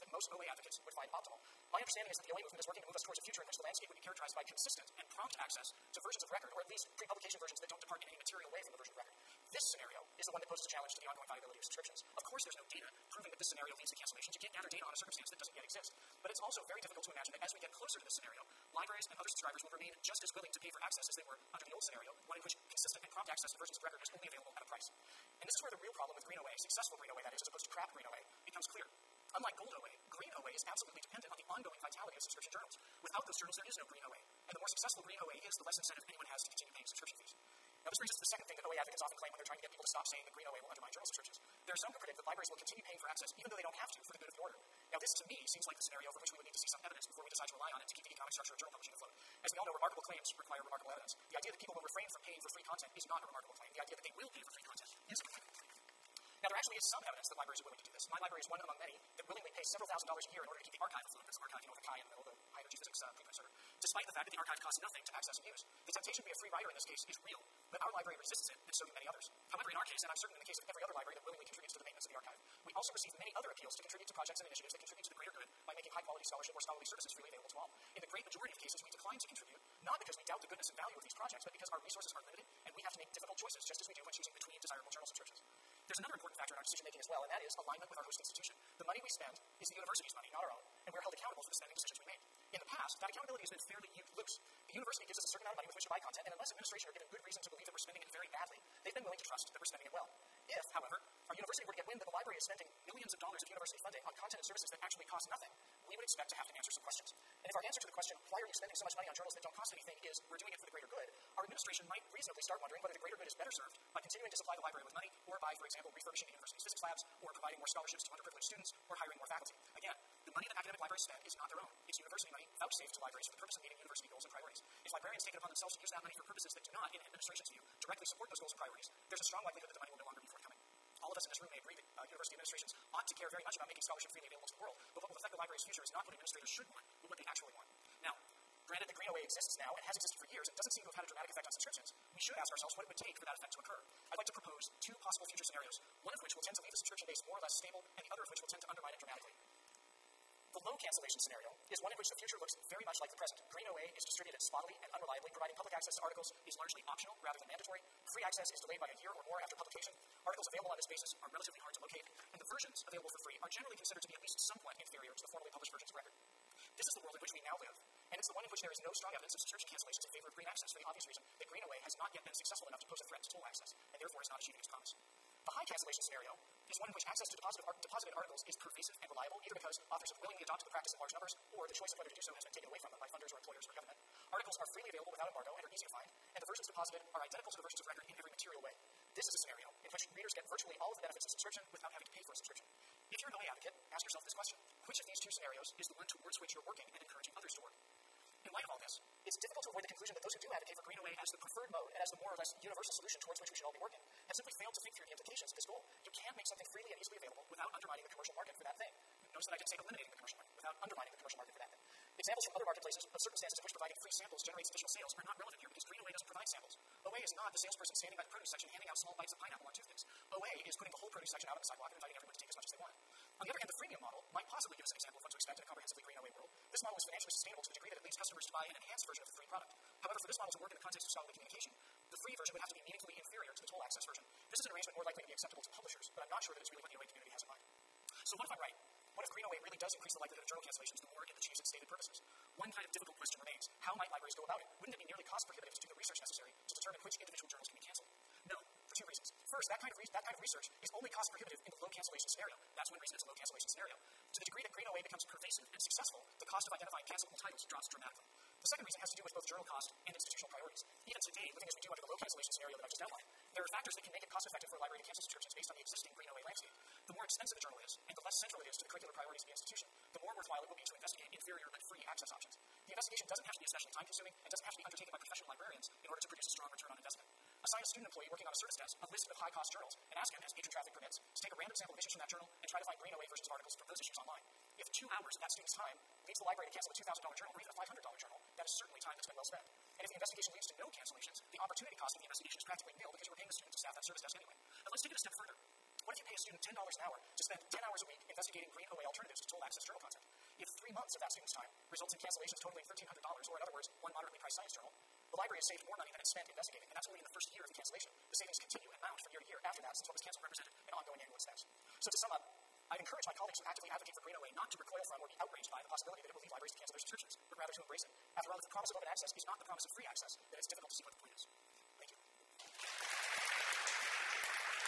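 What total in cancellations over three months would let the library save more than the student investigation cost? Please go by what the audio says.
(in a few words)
$1,300.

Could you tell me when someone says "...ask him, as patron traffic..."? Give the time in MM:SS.
04:40.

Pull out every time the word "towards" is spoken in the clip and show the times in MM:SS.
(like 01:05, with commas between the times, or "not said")
00:03, 03:16, 03:23.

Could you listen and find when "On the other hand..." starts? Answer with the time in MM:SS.
03:43.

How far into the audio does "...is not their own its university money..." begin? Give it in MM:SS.
02:01.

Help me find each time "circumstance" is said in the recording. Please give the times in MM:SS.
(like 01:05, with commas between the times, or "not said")
00:14, 03:33.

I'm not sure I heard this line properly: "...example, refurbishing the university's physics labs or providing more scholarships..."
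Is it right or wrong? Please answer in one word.
right.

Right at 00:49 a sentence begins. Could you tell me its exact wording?
As we all know, remarkable claims require remarkable evidence.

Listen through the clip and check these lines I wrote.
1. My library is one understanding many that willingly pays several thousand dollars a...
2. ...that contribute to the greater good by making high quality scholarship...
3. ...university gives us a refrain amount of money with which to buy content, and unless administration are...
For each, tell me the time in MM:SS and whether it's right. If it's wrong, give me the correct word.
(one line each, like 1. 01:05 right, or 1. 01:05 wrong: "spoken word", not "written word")
1. 00:58 wrong: "among", not "understanding"
2. 01:14 right
3. 01:34 wrong: "certain", not "refrain".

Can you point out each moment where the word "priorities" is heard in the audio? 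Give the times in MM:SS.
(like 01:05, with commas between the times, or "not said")
02:04, 02:08, 04:20, 04:29.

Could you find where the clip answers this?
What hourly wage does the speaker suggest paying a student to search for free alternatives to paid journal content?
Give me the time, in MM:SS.
04:56.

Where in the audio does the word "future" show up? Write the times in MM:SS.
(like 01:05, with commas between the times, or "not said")
00:03, 02:15, 02:25, 02:32.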